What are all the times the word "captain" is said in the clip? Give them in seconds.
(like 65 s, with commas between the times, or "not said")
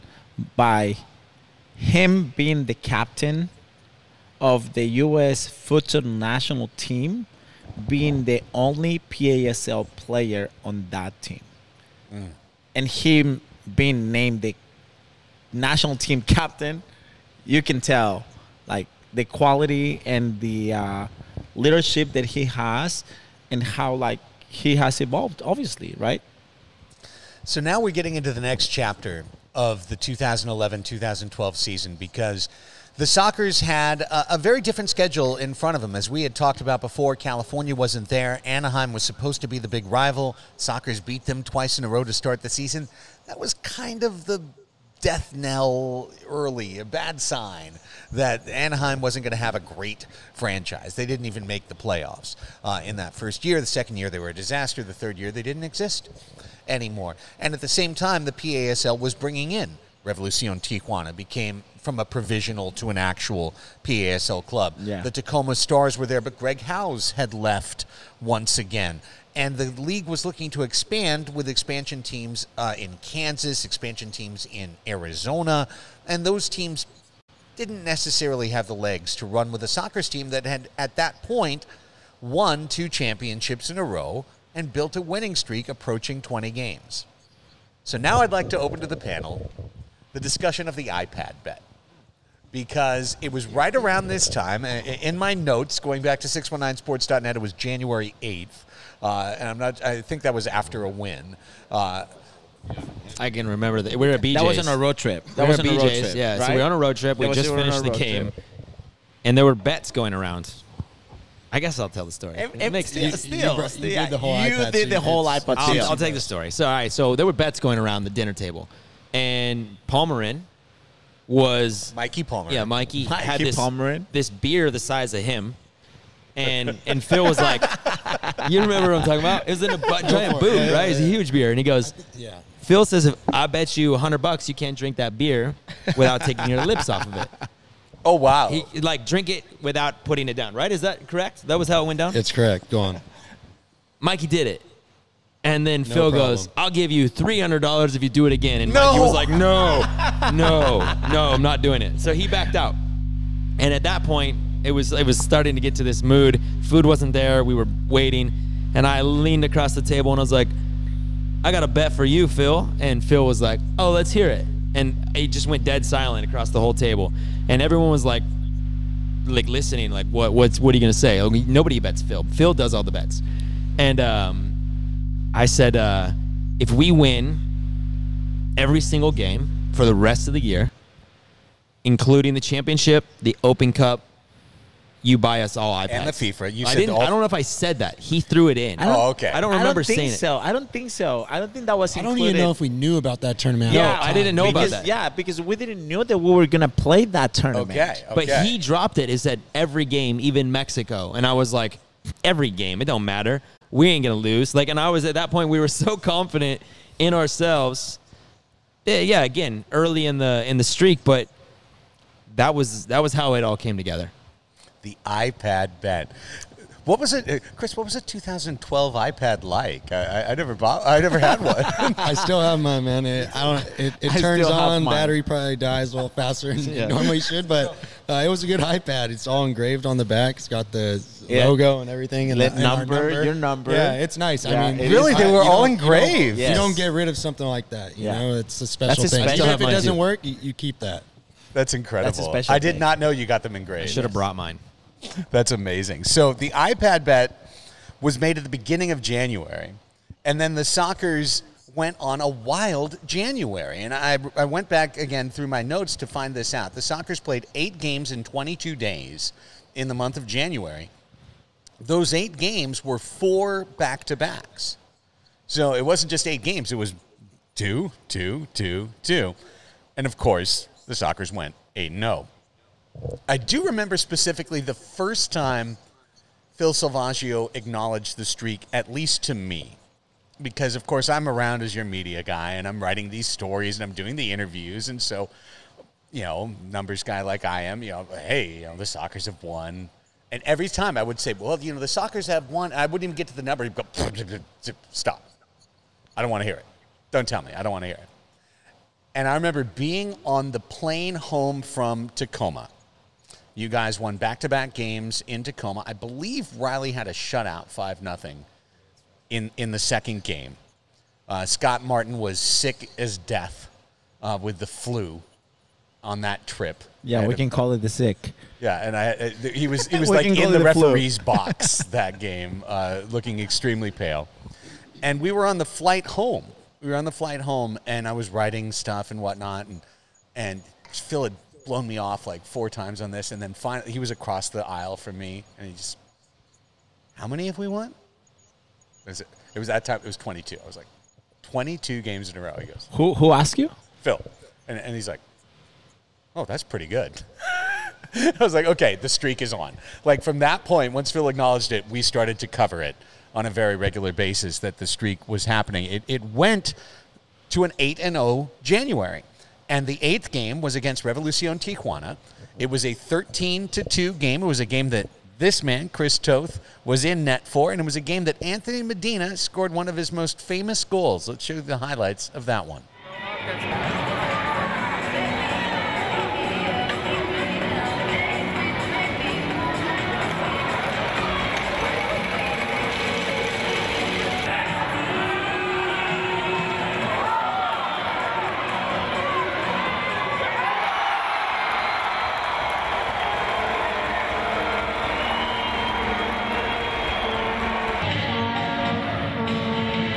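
2 s, 16 s.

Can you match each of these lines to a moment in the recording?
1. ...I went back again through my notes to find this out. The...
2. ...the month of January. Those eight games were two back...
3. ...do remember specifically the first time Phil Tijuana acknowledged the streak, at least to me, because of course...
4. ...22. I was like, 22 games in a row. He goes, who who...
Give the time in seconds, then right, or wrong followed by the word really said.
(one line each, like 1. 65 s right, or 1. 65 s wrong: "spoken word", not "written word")
1. 254 s right
2. 259 s wrong: "four", not "two"
3. 273 s wrong: "Salvagio", not "Tijuana"
4. 340 s right.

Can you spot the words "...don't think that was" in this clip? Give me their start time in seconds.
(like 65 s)
191 s.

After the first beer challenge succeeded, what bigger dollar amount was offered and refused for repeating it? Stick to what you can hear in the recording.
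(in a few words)
300.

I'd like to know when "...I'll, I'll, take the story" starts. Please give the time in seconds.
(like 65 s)
115 s.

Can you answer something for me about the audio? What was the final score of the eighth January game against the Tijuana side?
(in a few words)
13 to 2.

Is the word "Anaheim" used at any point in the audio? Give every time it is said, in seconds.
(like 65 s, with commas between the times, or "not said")
38 s, 48 s.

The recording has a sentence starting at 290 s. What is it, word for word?
And every time I would say, well, you know, the Sockers have won.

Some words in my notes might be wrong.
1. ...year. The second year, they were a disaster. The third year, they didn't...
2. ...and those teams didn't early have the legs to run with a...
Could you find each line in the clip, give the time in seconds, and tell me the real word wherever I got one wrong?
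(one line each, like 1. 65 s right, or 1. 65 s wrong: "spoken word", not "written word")
1. 53 s right
2. 76 s wrong: "necessarily", not "early".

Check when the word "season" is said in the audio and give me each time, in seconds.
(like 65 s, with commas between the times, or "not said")
31 s, 42 s.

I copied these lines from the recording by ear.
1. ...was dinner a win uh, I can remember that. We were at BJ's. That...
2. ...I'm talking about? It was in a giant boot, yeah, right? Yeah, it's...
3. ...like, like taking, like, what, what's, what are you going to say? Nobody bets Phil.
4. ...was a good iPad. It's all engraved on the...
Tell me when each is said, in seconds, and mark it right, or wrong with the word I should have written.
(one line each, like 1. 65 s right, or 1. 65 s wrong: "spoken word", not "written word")
1. 100 s wrong: "after", not "dinner"
2. 128 s right
3. 168 s wrong: "listening", not "taking"
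4. 228 s right.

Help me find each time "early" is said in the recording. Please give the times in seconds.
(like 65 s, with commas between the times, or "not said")
46 s, 209 s.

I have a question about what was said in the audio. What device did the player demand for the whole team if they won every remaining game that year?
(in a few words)
iPads.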